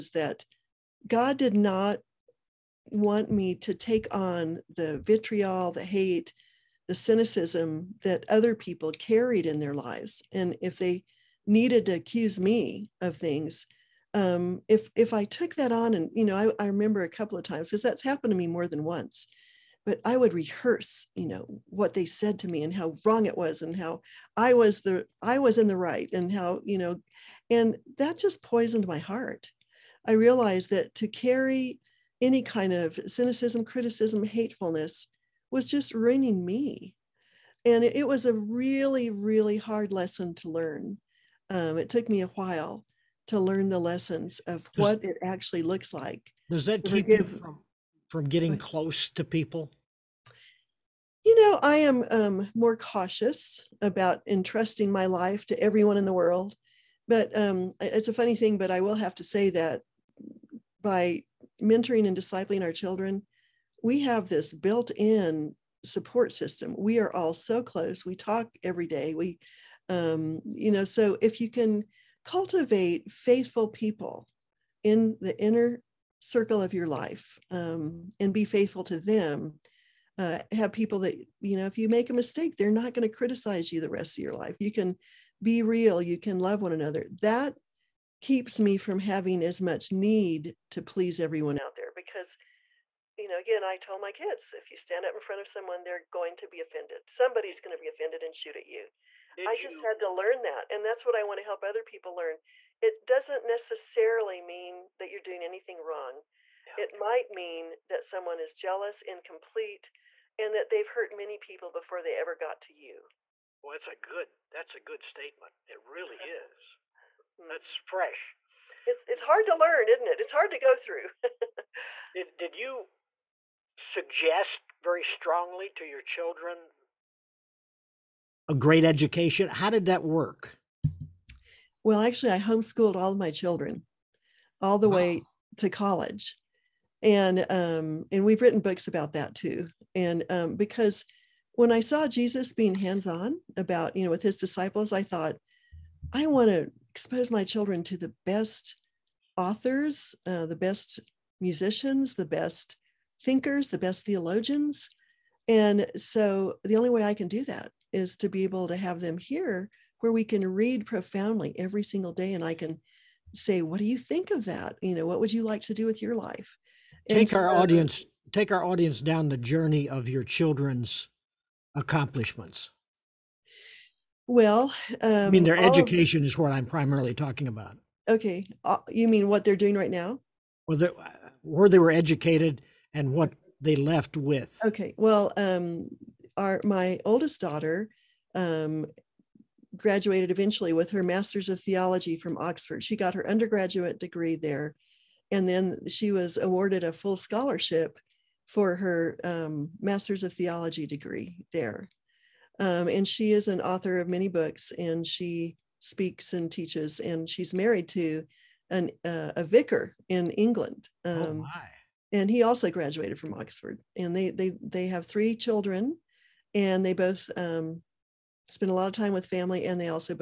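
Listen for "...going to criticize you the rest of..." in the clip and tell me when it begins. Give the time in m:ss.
1:22.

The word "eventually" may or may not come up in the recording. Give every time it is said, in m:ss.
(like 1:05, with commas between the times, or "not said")
3:10.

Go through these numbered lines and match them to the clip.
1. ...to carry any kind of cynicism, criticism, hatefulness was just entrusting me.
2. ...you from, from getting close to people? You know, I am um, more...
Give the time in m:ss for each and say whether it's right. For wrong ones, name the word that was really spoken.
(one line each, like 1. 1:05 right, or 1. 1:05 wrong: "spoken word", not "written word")
1. 0:30 wrong: "ruining", not "entrusting"
2. 0:47 right.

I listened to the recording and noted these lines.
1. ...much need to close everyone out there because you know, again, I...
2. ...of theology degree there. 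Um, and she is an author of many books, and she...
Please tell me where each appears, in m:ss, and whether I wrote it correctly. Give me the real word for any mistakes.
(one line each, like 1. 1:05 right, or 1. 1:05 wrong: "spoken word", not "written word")
1. 1:29 wrong: "please", not "close"
2. 3:20 right.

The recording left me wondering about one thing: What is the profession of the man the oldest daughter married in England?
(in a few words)
Vicar.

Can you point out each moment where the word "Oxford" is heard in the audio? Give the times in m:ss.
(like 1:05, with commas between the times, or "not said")
3:12, 3:33.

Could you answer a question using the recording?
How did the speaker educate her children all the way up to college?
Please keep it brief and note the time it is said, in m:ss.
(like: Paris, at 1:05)
Homeschooled, at 2:12.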